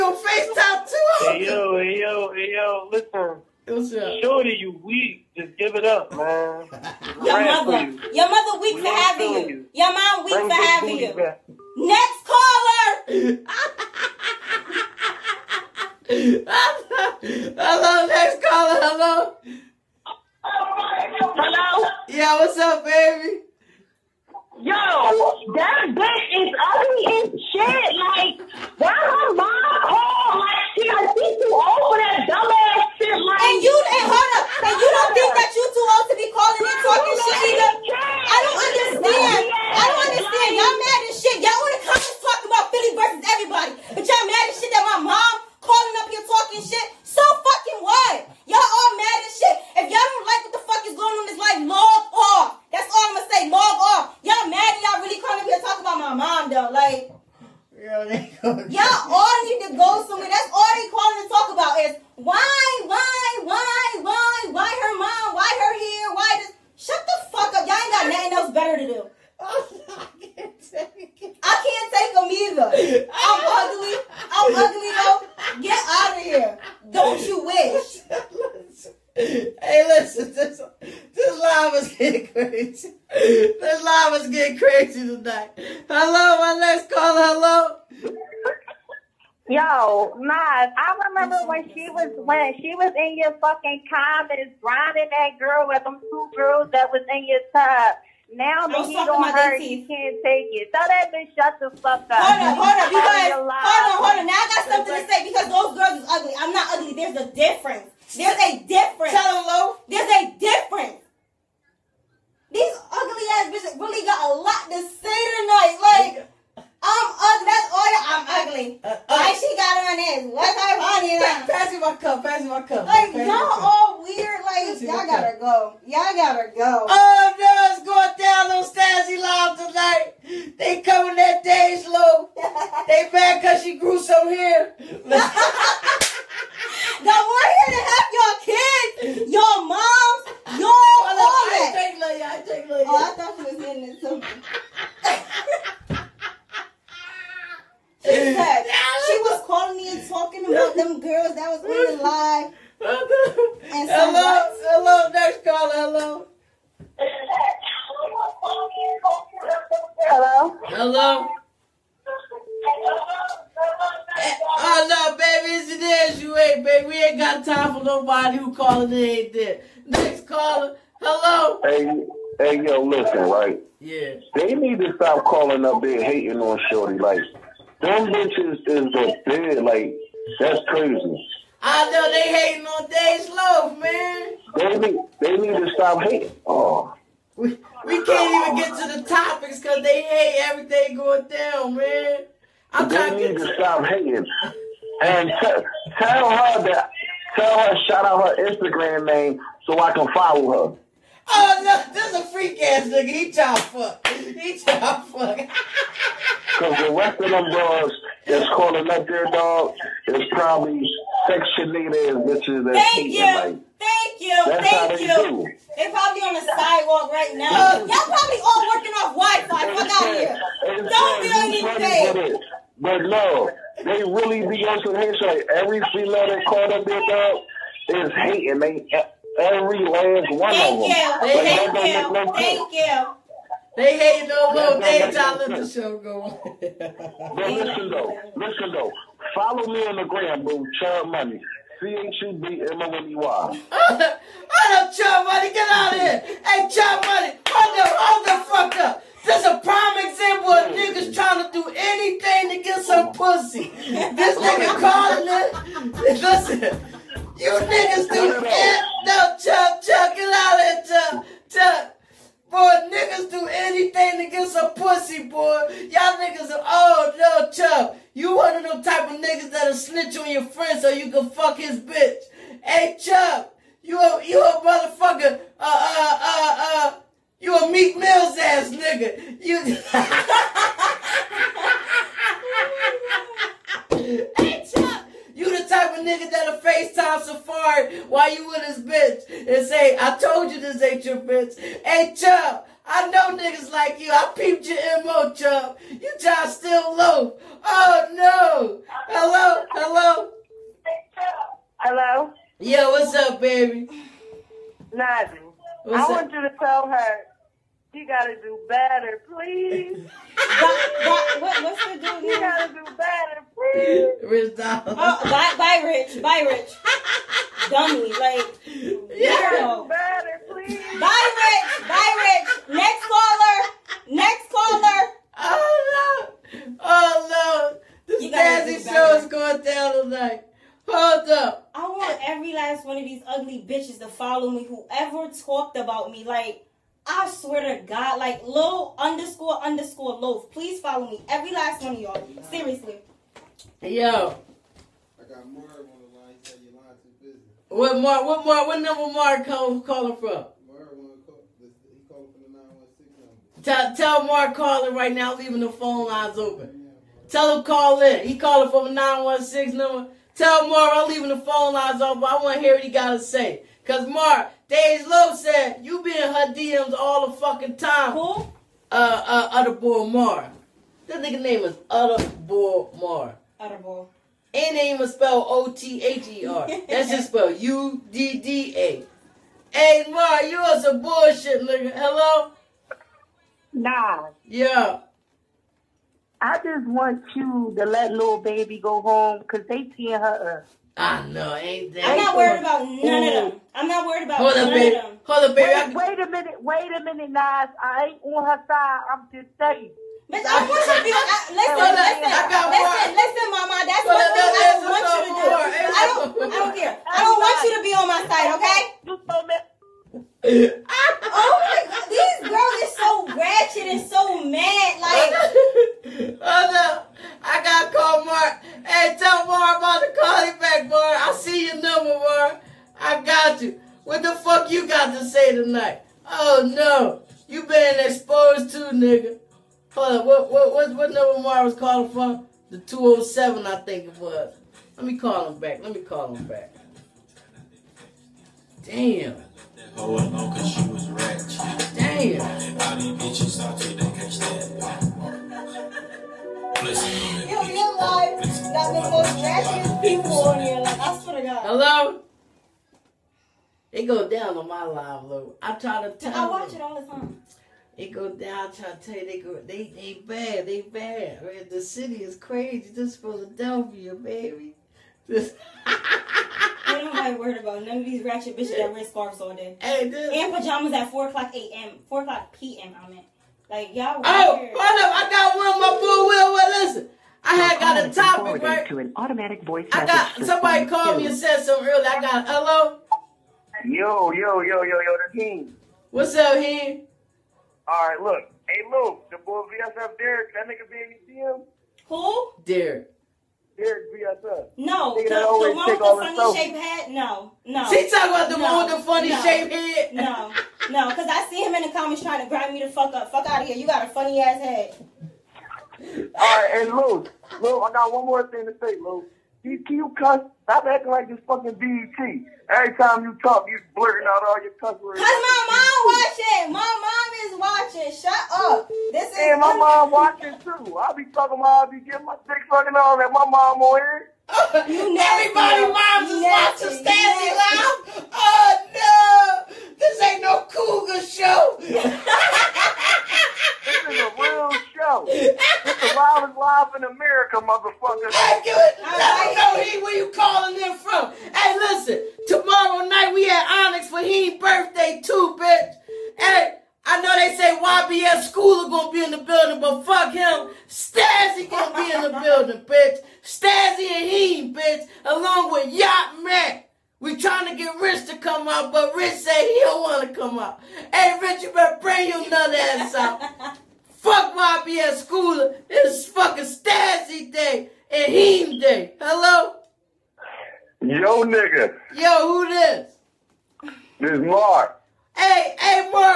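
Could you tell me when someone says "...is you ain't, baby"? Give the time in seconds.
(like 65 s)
166 s.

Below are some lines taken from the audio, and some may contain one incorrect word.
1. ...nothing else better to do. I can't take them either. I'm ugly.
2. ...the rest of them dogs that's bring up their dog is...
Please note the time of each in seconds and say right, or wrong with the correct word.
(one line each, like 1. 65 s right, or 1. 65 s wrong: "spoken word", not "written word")
1. 68 s right
2. 206 s wrong: "calling", not "bring".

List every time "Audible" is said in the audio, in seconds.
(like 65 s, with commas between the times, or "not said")
373 s.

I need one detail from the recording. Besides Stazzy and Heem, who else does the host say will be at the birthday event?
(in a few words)
Yacht Mac.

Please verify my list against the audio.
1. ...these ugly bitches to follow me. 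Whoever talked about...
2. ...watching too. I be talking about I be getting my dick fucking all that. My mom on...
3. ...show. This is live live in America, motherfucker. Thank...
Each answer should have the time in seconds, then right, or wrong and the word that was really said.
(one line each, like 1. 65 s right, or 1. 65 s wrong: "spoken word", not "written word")
1. 333 s right
2. 520 s right
3. 534 s right.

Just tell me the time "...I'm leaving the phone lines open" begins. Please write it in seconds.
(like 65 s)
360 s.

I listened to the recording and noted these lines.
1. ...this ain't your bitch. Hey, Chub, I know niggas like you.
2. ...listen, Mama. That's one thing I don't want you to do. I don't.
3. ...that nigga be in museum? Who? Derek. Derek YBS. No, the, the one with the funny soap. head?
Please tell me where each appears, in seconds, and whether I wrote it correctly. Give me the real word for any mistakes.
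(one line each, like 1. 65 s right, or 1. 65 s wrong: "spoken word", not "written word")
1. 290 s right
2. 403 s right
3. 490 s wrong: "VSF", not "YBS".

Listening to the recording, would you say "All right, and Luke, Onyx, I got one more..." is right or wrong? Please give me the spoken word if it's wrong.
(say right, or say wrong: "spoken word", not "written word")
wrong: "Luke", not "Onyx".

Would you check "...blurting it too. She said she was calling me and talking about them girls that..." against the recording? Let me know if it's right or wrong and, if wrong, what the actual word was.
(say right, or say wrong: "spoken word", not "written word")
wrong: "hitting", not "blurting".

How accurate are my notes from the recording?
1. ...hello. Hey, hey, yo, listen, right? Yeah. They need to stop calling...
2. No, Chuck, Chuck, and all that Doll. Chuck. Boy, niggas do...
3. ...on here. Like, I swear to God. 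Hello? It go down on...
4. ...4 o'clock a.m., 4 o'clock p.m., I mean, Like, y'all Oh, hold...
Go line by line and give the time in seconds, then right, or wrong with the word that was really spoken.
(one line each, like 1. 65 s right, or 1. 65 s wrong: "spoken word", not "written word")
1. 170 s right
2. 259 s wrong: "Chuck", not "Doll"
3. 450 s right
4. 471 s right.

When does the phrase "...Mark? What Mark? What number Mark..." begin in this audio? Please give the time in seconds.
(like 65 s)
347 s.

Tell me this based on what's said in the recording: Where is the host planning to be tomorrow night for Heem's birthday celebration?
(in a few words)
Onyx.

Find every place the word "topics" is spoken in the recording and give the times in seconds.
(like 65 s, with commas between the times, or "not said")
189 s, 478 s.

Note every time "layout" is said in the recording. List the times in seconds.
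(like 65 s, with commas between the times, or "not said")
not said.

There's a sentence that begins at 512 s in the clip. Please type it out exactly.
Every time you talk, you blurting out all your cuss words.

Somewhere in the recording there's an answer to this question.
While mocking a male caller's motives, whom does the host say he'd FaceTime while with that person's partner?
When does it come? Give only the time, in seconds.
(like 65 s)
287 s.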